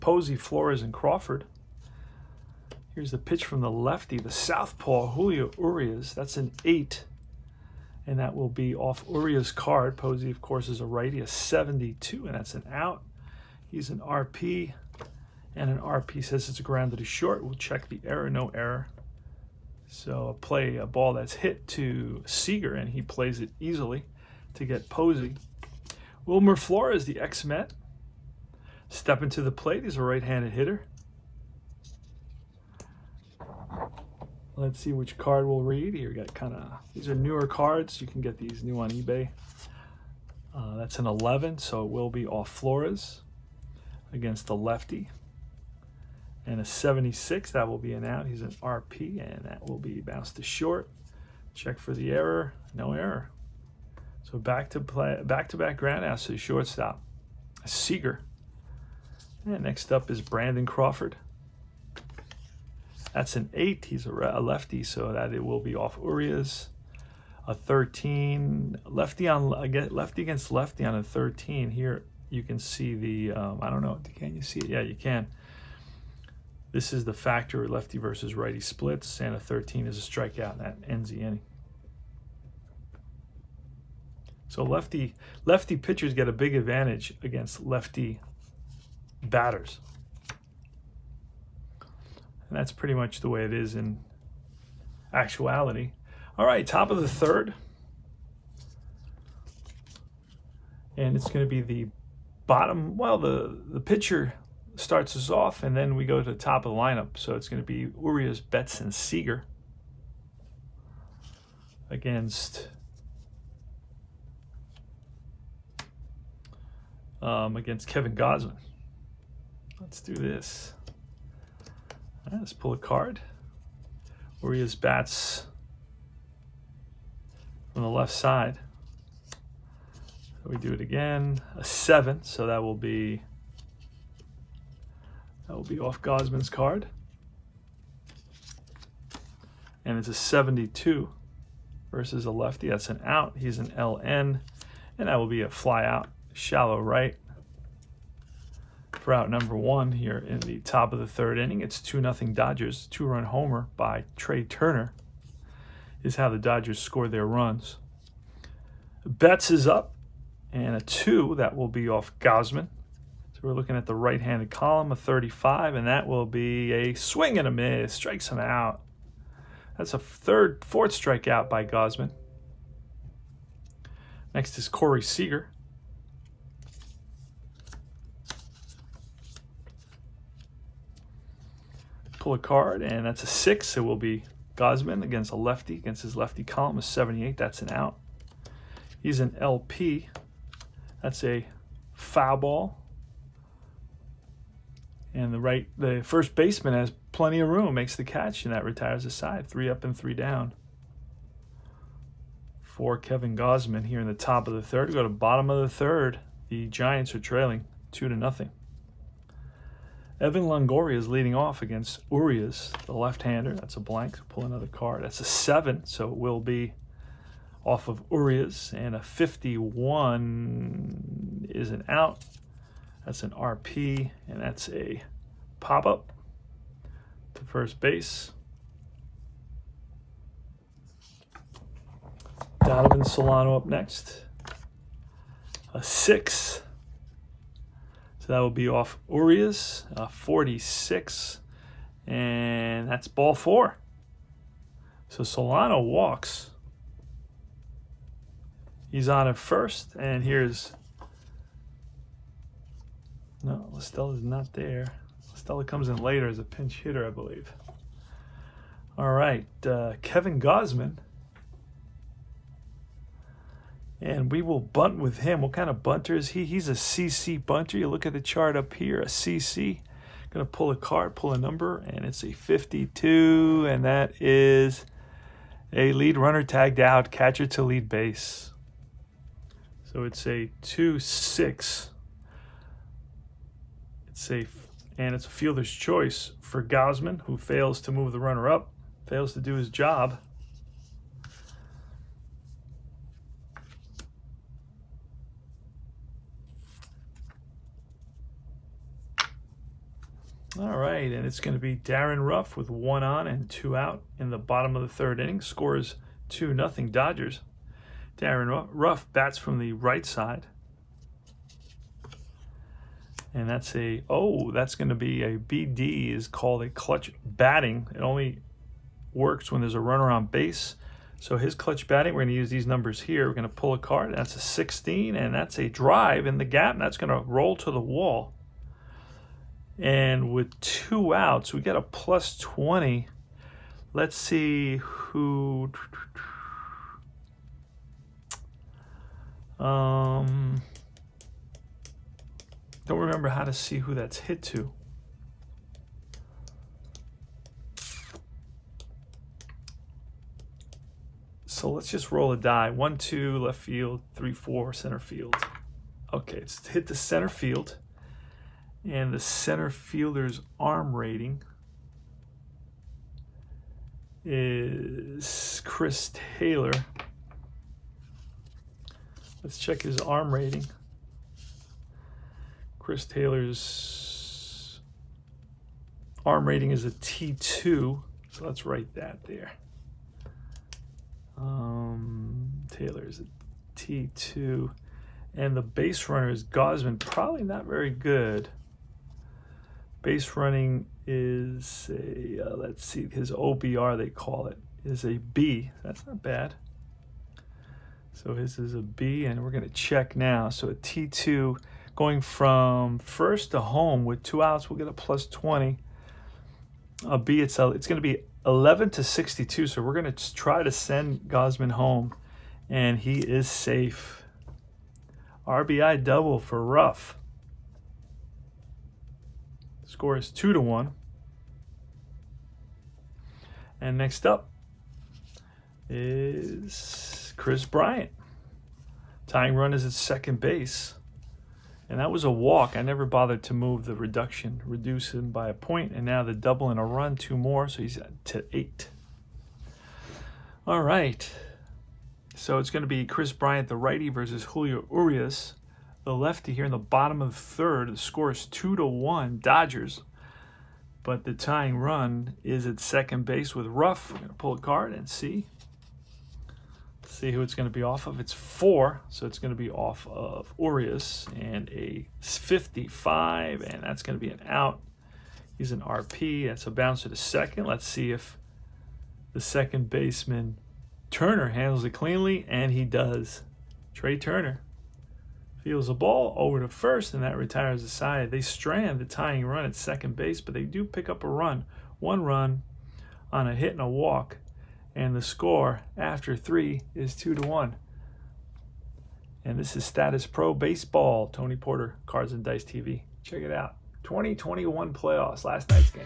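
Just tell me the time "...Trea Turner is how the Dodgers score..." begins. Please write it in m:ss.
2:34.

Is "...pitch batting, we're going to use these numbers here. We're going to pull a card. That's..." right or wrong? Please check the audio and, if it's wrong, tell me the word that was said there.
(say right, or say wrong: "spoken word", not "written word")
wrong: "clutch", not "pitch".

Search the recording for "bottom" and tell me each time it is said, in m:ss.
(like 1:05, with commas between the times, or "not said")
1:42, 3:25, 5:04, 7:26.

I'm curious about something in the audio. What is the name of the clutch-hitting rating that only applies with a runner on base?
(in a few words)
BD.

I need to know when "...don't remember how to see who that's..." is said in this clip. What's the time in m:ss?
5:42.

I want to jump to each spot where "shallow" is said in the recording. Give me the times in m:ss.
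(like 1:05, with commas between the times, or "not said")
2:26.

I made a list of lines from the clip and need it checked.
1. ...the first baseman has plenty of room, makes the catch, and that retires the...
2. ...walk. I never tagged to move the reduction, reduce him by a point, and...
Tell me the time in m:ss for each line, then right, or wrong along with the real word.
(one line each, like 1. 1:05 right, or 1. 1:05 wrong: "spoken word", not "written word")
1. 3:15 right
2. 7:12 wrong: "bothered", not "tagged".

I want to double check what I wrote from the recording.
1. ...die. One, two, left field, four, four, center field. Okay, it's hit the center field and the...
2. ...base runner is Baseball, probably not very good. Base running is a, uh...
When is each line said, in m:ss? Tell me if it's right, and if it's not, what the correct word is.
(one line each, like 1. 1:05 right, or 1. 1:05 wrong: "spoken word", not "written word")
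1. 5:52 wrong: "three", not "four"
2. 6:25 wrong: "Gausman", not "Baseball".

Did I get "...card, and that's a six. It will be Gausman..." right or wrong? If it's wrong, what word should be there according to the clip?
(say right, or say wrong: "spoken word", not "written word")
right.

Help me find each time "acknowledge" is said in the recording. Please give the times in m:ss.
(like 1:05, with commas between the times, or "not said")
not said.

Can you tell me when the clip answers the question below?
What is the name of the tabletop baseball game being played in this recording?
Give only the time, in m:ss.
8:09.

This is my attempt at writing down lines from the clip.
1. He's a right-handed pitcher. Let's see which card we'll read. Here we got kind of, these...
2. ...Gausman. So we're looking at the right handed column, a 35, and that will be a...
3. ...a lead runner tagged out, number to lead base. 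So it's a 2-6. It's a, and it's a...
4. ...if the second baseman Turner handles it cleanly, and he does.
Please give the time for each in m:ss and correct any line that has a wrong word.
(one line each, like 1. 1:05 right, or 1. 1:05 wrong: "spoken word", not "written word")
1. 0:29 wrong: "hitter", not "pitcher"
2. 2:42 right
3. 4:35 wrong: "catcher", not "number"
4. 7:48 right.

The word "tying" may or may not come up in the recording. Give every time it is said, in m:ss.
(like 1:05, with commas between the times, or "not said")
7:09, 7:31, 7:59.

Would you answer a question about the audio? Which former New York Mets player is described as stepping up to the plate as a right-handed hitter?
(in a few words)
Wilmer Flores.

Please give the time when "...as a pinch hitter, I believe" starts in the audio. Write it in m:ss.
4:16.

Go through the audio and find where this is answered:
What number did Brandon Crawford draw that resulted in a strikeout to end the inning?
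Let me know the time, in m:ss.
1:19.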